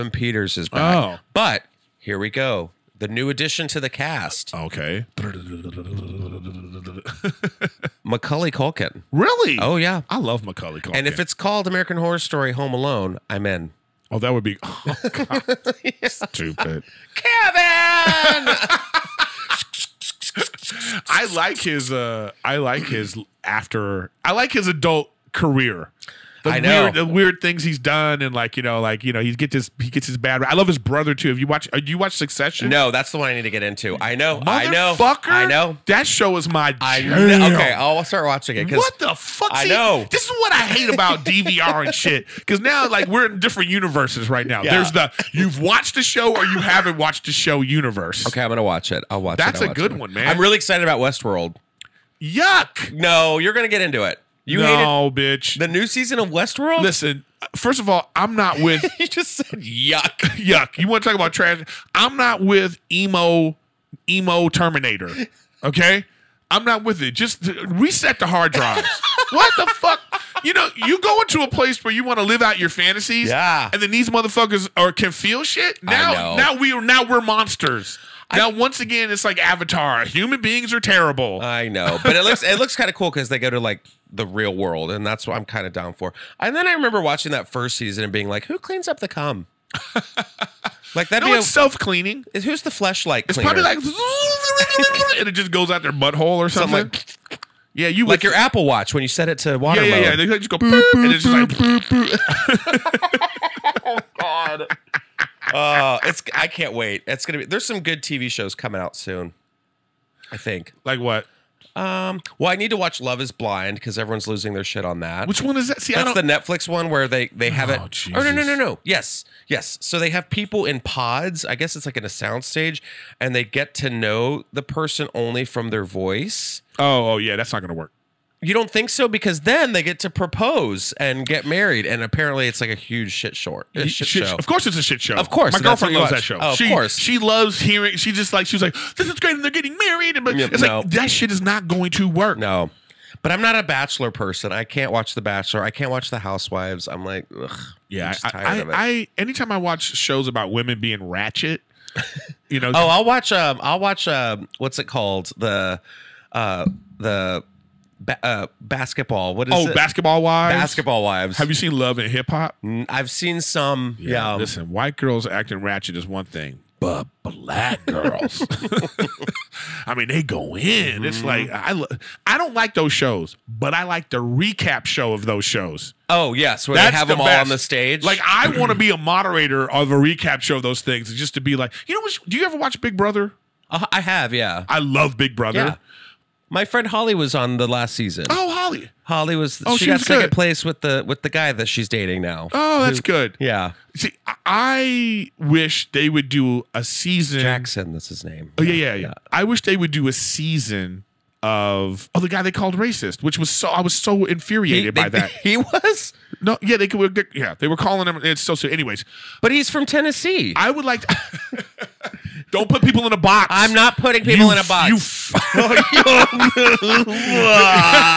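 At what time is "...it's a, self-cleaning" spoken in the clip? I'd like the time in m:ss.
1:31.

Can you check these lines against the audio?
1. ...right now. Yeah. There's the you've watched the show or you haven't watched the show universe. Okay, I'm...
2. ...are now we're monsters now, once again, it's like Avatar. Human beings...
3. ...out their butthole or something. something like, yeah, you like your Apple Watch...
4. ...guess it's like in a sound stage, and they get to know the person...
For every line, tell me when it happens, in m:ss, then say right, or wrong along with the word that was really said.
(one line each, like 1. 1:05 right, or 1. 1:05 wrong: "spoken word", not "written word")
1. 0:44 right
2. 1:16 right
3. 1:35 right
4. 2:01 right.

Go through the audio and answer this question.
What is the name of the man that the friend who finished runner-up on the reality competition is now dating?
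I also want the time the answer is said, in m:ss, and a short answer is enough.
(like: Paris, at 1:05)
Jackson, at 3:17.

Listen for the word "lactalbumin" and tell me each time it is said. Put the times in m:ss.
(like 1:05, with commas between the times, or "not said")
not said.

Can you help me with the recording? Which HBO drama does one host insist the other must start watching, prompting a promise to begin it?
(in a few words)
Succession.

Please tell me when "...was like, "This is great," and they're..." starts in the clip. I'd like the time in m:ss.
2:18.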